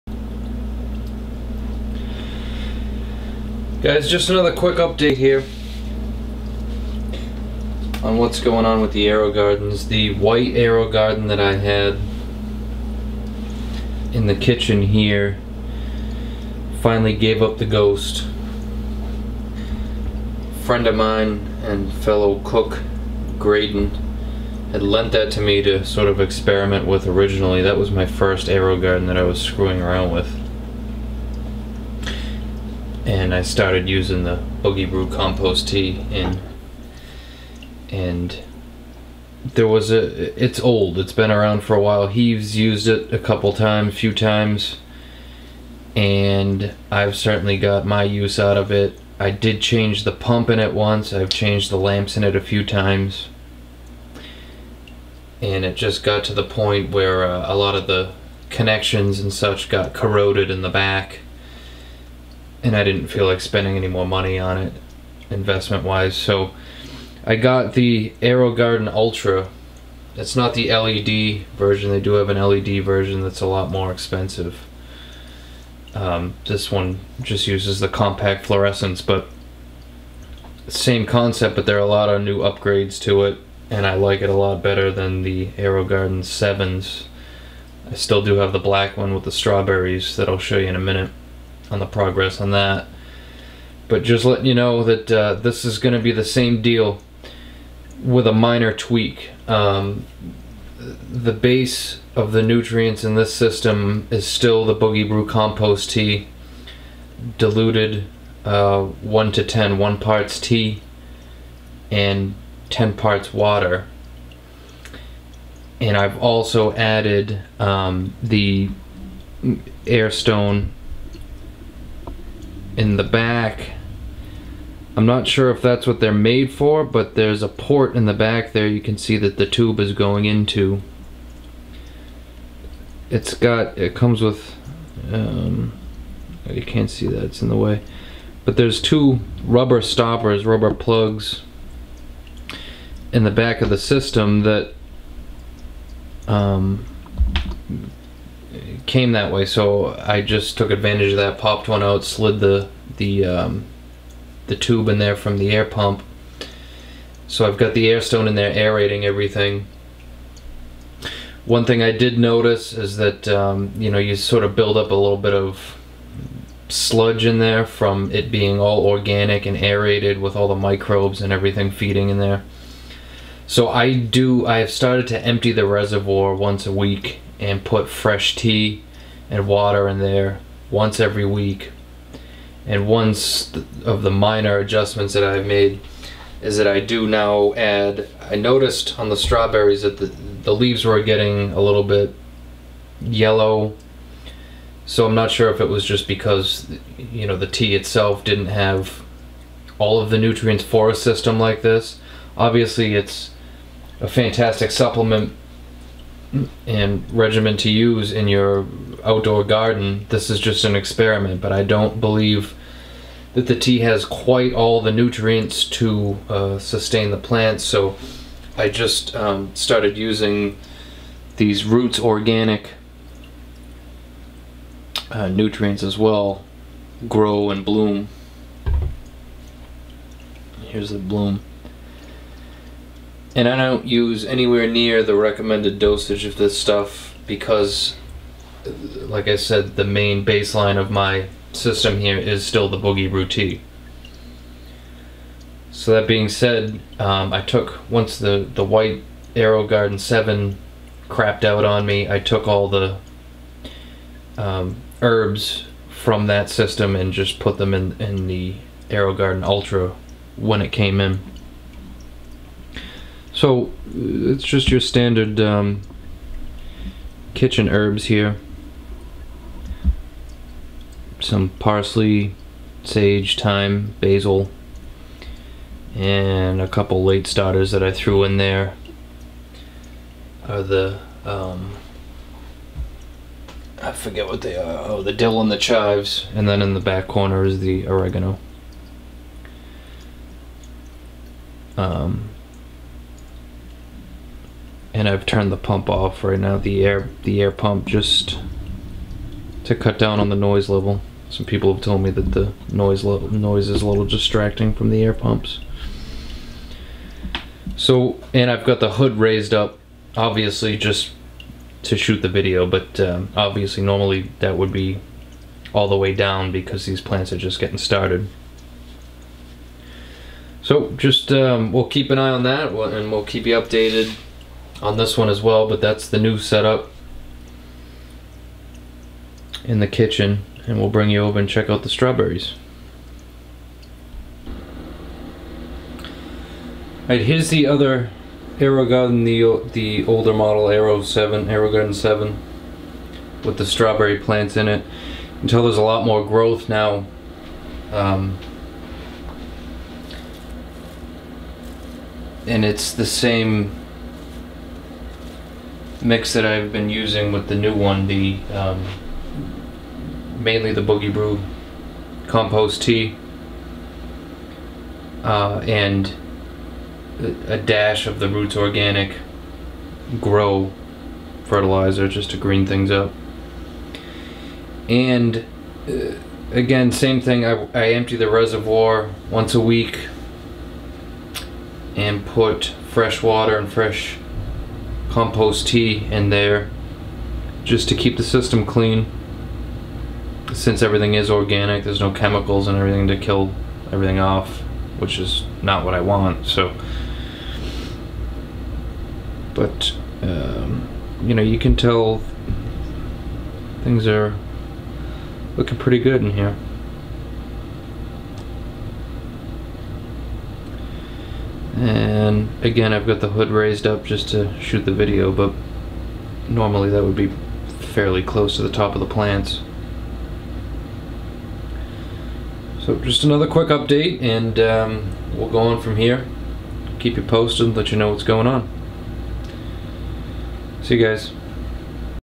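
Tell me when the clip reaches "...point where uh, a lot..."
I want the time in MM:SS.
00:56.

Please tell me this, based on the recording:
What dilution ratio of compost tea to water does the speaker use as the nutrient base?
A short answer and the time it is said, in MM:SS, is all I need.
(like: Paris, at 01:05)
1 to 10, at 01:48.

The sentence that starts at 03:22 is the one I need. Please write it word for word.
Obviously it's a fantastic supplement and regimen to use in your outdoor garden.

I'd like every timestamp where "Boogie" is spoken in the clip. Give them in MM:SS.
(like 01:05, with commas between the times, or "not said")
00:34, 01:44, 04:02, 06:00.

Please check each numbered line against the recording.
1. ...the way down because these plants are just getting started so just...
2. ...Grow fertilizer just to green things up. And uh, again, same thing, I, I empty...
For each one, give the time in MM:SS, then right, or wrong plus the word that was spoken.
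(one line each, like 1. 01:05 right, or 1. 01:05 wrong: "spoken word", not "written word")
1. 05:15 right
2. 06:10 right.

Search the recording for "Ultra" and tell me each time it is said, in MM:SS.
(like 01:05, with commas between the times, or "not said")
01:08, 04:19.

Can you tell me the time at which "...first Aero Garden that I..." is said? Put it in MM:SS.
00:28.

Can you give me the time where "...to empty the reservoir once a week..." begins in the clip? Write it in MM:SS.
02:55.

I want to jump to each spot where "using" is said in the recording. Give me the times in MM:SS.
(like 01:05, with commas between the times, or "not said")
00:33, 03:39, 05:56.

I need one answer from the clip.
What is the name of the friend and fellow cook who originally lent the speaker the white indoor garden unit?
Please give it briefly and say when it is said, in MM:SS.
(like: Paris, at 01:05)
Graydon, at 00:23.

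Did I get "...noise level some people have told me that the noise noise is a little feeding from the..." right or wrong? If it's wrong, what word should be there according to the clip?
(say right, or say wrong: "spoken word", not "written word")
wrong: "distracting", not "feeding".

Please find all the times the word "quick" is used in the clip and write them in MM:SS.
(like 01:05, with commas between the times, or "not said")
00:04, 07:03.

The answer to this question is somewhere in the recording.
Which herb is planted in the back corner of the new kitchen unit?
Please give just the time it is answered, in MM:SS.
04:47.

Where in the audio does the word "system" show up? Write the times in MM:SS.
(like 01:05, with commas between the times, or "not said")
01:43, 02:23, 03:20, 04:01, 04:16, 06:28.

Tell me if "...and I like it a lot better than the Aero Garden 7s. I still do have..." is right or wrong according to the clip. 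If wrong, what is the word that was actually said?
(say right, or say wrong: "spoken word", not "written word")
right.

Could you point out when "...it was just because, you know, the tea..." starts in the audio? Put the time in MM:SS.
03:15.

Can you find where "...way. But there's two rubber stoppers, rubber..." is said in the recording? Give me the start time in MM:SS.
02:17.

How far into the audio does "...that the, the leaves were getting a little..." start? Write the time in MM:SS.
03:09.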